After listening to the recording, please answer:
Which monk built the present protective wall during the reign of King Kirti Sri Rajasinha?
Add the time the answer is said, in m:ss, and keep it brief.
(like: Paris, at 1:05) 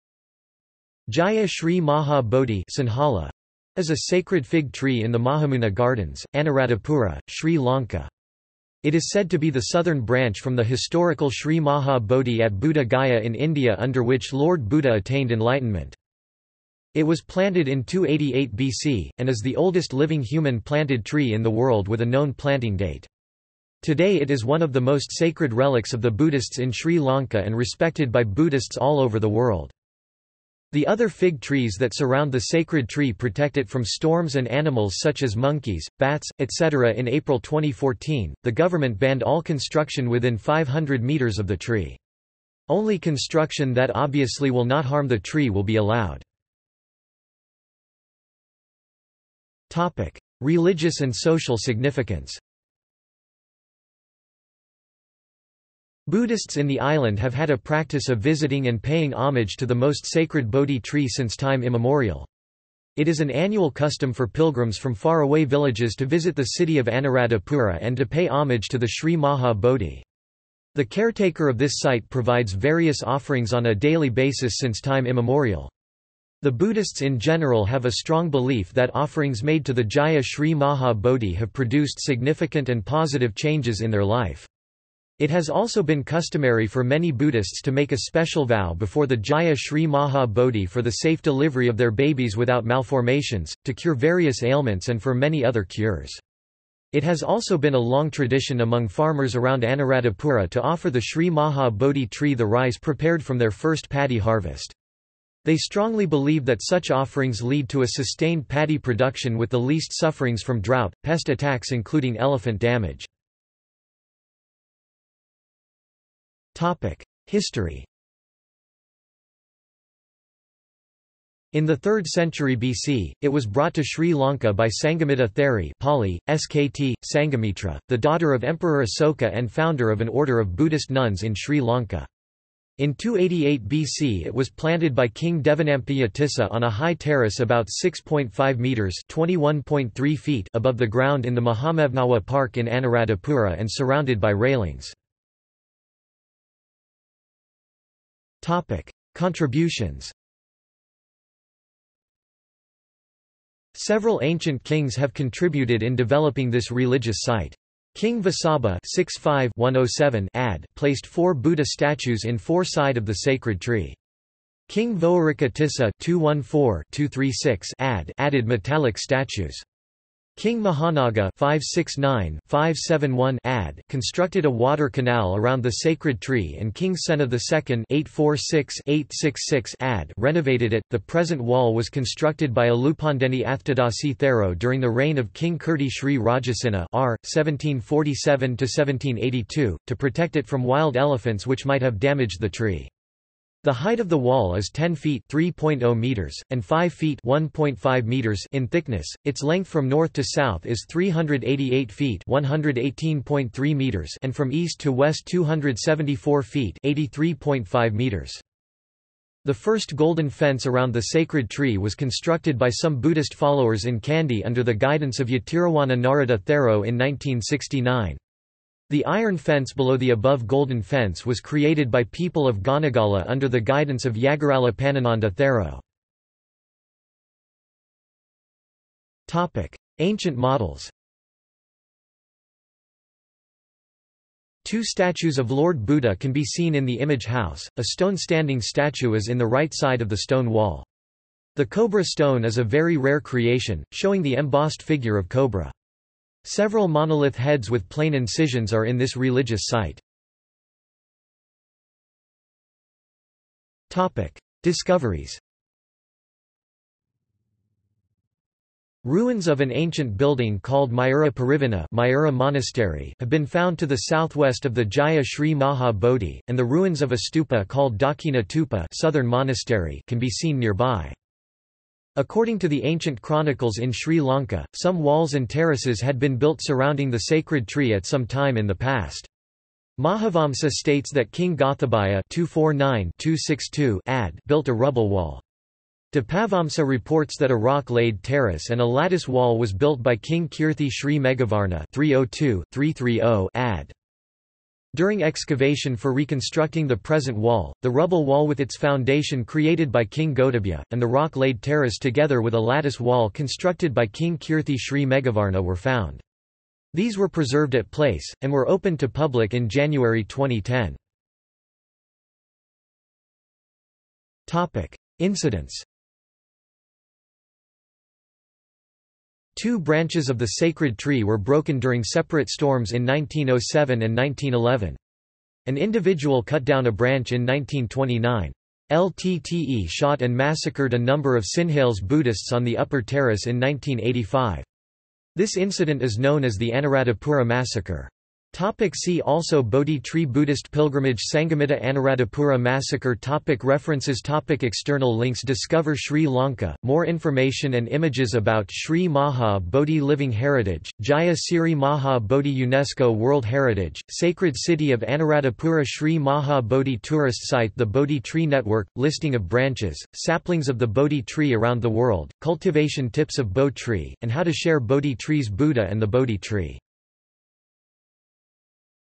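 Alupandeni Athadasi Thero, at 3:02.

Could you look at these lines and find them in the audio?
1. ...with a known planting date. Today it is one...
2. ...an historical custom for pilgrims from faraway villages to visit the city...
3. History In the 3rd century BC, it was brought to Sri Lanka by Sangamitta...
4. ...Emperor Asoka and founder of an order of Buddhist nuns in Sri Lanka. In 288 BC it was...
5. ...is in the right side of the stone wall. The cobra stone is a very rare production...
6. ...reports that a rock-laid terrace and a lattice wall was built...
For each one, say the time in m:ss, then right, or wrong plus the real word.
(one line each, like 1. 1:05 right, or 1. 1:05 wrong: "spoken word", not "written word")
1. 0:21 right
2. 1:03 wrong: "annual", not "historical"
3. 1:57 right
4. 2:08 right
5. 3:59 wrong: "creation", not "production"
6. 4:46 right.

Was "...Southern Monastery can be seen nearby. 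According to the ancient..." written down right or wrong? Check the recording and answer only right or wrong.
right.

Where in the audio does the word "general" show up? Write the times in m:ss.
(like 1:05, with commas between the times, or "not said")
1:17.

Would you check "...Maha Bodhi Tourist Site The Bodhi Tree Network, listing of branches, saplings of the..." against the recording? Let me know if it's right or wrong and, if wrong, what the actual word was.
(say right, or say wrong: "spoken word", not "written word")
right.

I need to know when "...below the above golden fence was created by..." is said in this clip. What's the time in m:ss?
3:39.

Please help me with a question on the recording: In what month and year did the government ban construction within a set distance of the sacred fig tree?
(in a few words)
April 2014.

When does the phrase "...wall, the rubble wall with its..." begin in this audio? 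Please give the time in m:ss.
4:57.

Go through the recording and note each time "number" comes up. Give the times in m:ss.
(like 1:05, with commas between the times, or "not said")
5:30.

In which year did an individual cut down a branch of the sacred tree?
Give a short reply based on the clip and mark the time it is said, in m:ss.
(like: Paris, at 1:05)
1929, at 5:27.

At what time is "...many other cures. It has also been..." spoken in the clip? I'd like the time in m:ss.
1:35.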